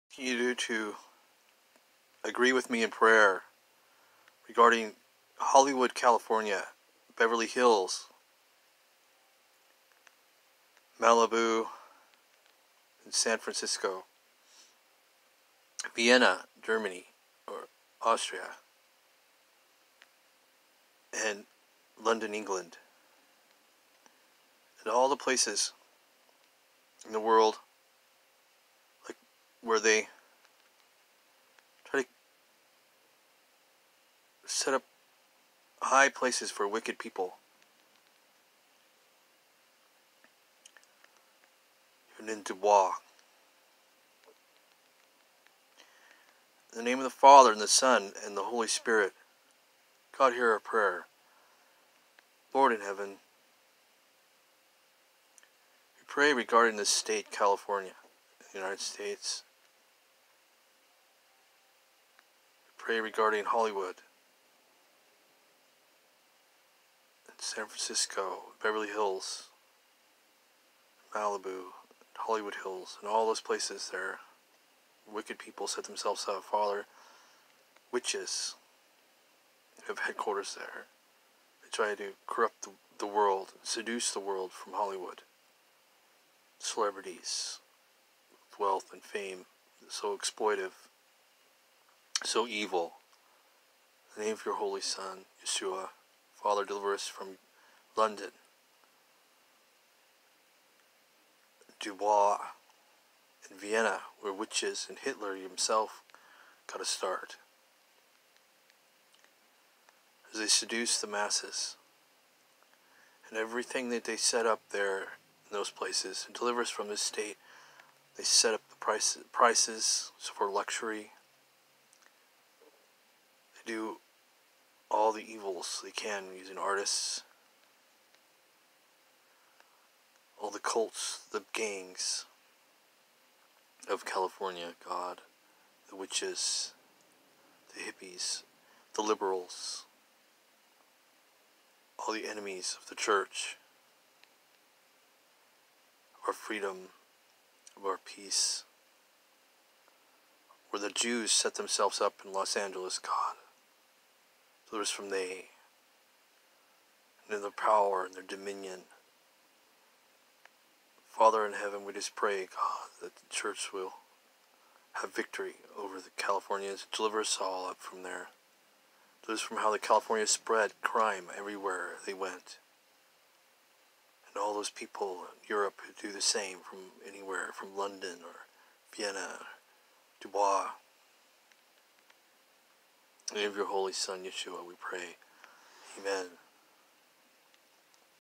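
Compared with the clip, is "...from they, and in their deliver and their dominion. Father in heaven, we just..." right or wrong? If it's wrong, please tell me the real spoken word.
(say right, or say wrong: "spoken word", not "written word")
wrong: "power", not "deliver".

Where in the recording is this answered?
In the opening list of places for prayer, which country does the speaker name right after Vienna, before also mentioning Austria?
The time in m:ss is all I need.
0:16.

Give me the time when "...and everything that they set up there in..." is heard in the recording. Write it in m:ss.
1:53.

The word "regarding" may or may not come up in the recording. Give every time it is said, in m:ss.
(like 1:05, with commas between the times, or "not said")
0:04, 0:56, 1:02.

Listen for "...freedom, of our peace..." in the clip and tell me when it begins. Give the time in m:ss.
2:26.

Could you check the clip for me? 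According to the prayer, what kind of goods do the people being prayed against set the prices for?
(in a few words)
luxury.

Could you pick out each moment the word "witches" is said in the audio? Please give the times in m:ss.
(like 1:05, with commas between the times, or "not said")
1:17, 1:44, 2:15.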